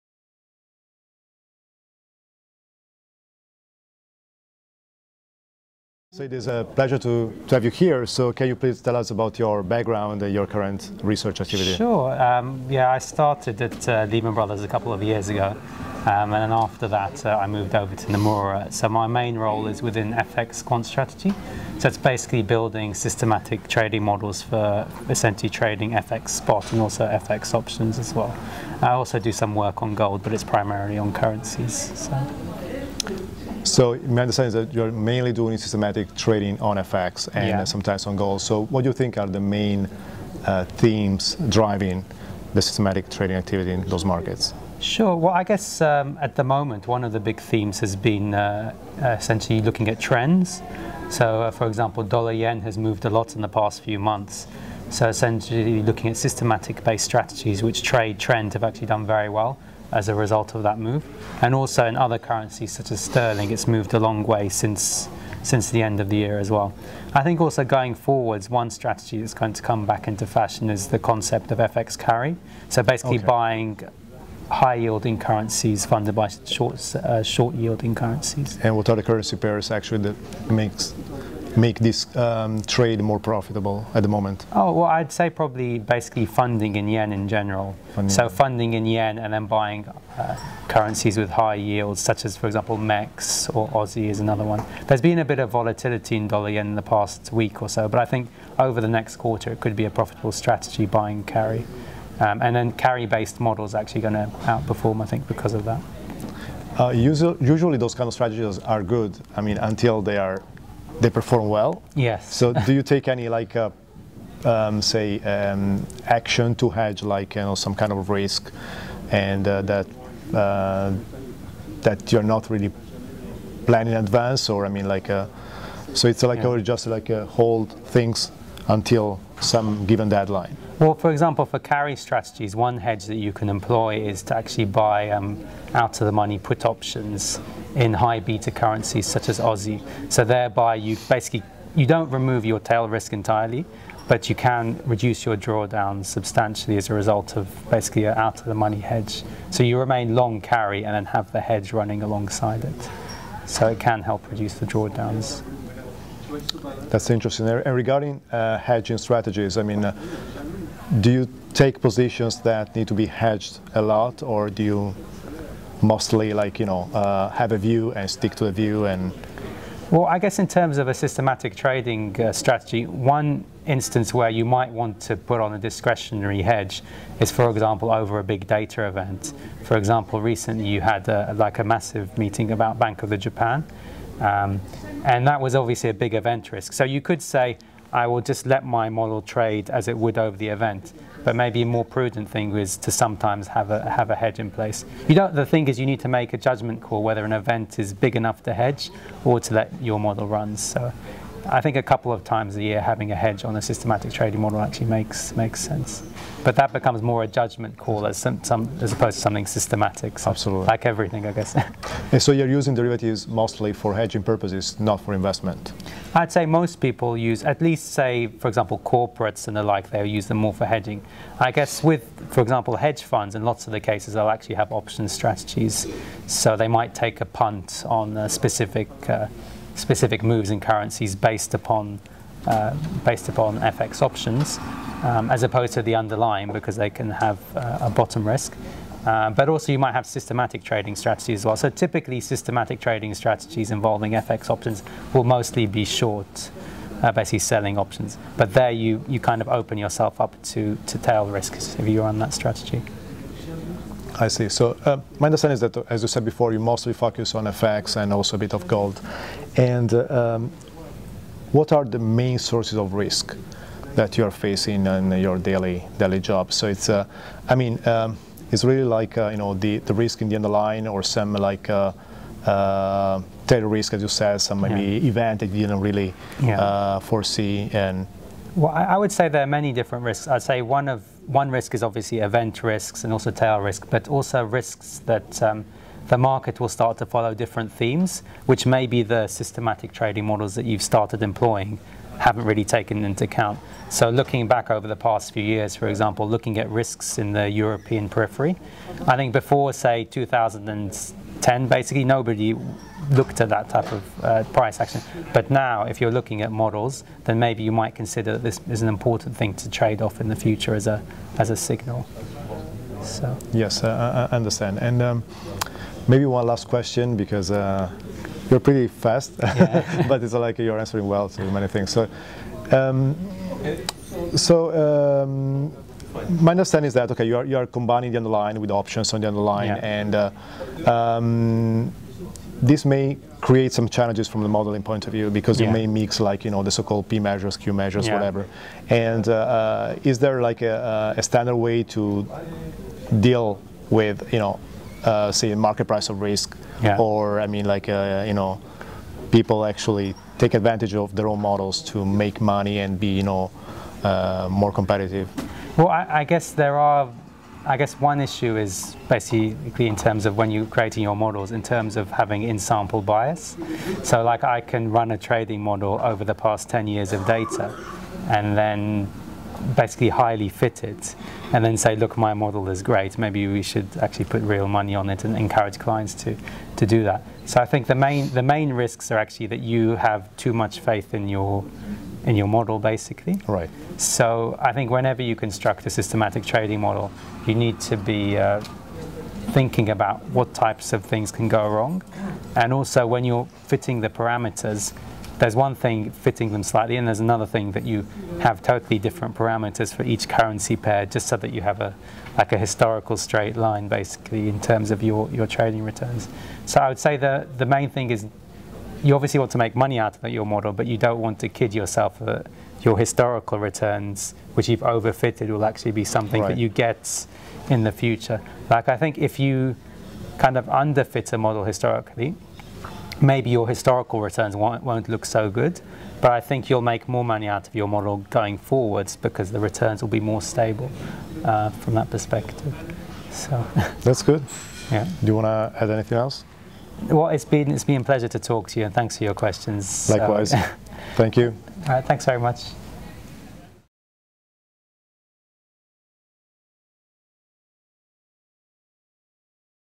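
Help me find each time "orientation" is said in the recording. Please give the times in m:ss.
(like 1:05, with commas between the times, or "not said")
not said.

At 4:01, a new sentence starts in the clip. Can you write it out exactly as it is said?
So typically systematic trading strategies involving FX options will mostly be short, uh, basically selling options.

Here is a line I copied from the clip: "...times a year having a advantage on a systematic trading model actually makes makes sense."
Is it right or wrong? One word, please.
wrong.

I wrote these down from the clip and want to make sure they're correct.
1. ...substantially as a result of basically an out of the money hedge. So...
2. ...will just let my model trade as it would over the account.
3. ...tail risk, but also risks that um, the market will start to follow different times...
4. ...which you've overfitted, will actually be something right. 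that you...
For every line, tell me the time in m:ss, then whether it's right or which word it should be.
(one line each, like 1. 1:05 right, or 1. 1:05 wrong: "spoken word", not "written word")
1. 2:26 right
2. 3:08 wrong: "event", not "account"
3. 4:43 wrong: "themes", not "times"
4. 6:54 right.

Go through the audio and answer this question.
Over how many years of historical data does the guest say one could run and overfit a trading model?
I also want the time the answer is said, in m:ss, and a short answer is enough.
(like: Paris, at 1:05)
10 years, at 6:06.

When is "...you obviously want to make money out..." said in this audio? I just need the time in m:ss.
6:49.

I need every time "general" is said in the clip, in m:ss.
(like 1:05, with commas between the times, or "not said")
1:27.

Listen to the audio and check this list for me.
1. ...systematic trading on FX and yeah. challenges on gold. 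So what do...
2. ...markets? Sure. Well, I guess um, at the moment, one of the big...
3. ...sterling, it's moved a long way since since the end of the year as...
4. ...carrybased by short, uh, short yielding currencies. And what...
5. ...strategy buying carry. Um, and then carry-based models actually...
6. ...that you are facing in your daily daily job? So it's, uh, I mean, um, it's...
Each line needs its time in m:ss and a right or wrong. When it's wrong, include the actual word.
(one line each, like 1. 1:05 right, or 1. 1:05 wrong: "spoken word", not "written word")
1. 0:35 wrong: "sometimes", not "challenges"
2. 0:44 right
3. 1:03 right
4. 1:15 wrong: "funded", not "carrybased"
5. 1:40 right
6. 4:23 right.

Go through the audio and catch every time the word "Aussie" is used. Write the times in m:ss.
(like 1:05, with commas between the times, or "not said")
1:33, 2:19.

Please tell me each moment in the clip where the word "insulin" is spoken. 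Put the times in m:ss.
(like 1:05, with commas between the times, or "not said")
not said.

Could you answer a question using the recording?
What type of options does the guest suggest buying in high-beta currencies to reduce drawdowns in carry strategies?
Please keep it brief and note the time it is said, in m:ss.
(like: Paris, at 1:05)
Out of the money put options, at 2:15.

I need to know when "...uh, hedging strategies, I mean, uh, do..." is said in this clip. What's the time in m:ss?
2:38.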